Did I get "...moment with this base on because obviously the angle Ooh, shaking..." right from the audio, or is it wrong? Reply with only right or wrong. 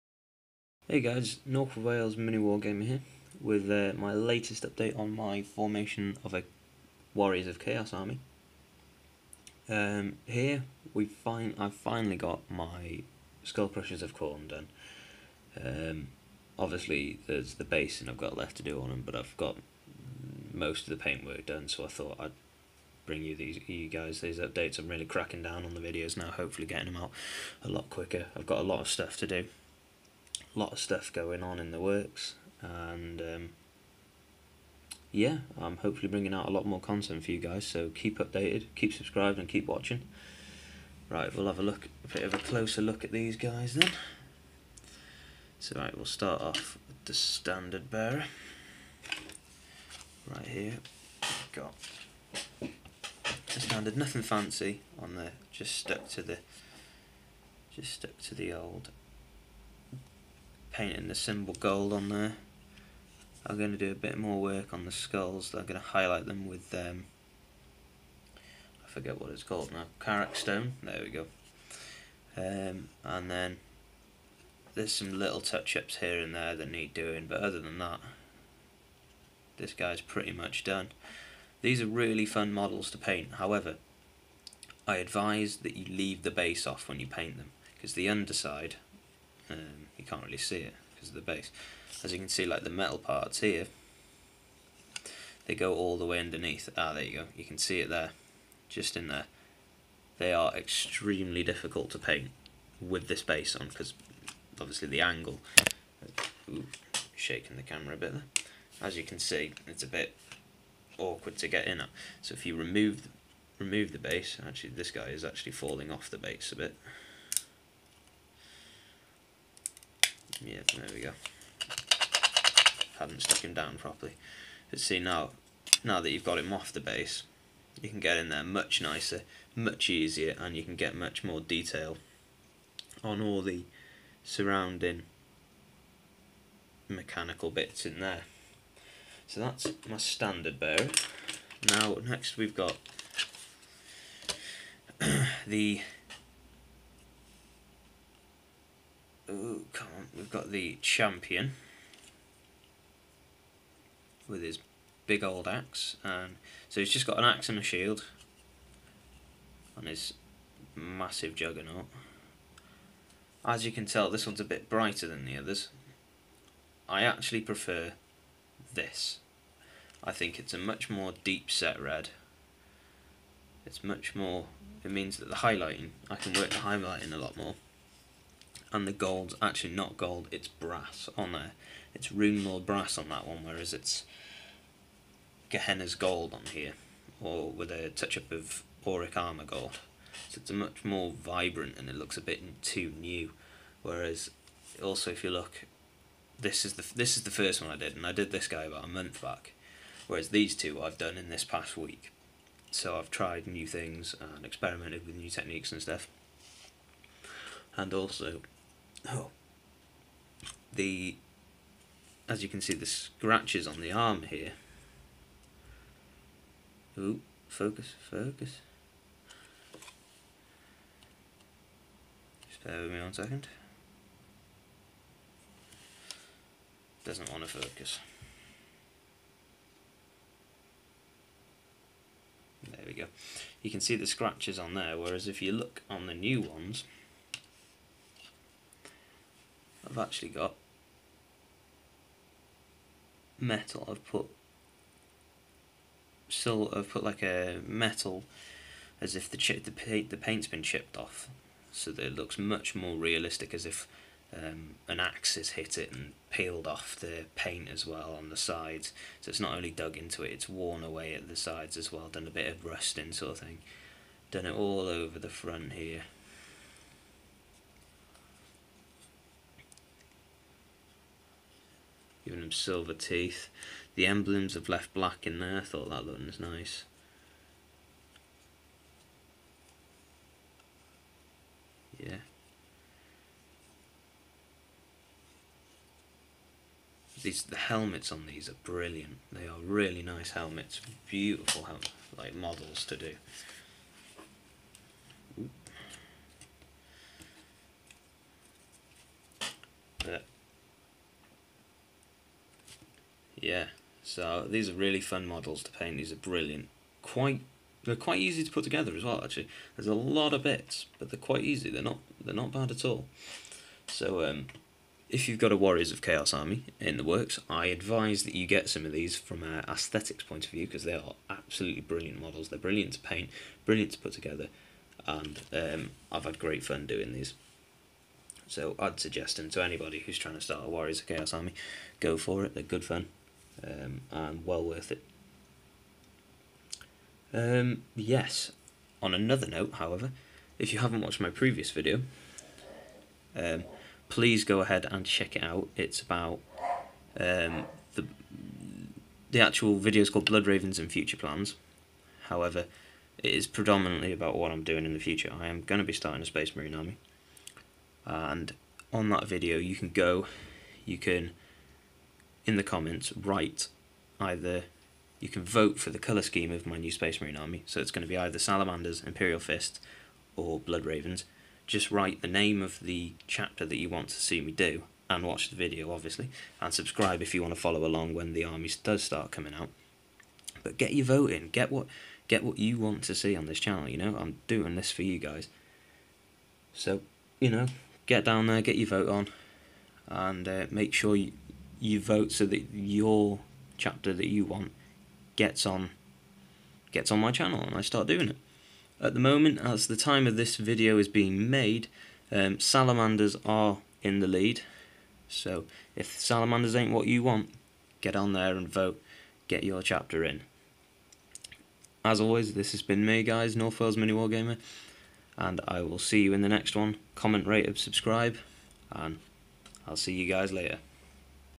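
wrong.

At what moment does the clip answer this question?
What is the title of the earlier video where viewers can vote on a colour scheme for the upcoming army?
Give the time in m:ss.
5:50.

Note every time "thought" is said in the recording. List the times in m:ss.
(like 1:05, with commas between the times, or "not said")
0:21, 4:35.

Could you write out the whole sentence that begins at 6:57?
Comment, rate, and subscribe, and I'll see you guys later.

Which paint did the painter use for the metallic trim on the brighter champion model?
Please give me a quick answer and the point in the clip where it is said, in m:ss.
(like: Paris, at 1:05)
Rune Lord brass, at 3:02.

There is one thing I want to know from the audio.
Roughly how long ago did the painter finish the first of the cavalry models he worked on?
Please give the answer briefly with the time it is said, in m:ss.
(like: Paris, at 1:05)
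a month, at 3:18.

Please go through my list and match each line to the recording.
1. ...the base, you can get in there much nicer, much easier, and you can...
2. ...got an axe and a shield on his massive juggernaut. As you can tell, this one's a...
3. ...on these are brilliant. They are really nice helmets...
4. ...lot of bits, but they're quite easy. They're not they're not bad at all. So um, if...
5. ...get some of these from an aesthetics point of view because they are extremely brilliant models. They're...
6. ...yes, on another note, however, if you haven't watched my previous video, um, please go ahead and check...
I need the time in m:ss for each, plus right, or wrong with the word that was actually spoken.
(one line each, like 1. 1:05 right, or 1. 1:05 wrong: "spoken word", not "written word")
1. 2:06 right
2. 2:37 right
3. 4:48 right
4. 5:09 right
5. 5:18 wrong: "absolutely", not "extremely"
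6. 5:37 right.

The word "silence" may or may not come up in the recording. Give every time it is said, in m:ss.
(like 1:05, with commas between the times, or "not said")
not said.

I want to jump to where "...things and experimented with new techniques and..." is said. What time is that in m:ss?
3:23.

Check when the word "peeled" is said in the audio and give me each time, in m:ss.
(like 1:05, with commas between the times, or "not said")
4:16.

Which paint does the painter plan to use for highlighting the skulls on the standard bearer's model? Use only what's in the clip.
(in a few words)
Karak Stone.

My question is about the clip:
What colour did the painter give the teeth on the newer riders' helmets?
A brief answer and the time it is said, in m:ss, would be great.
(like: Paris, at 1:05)
silver, at 4:32.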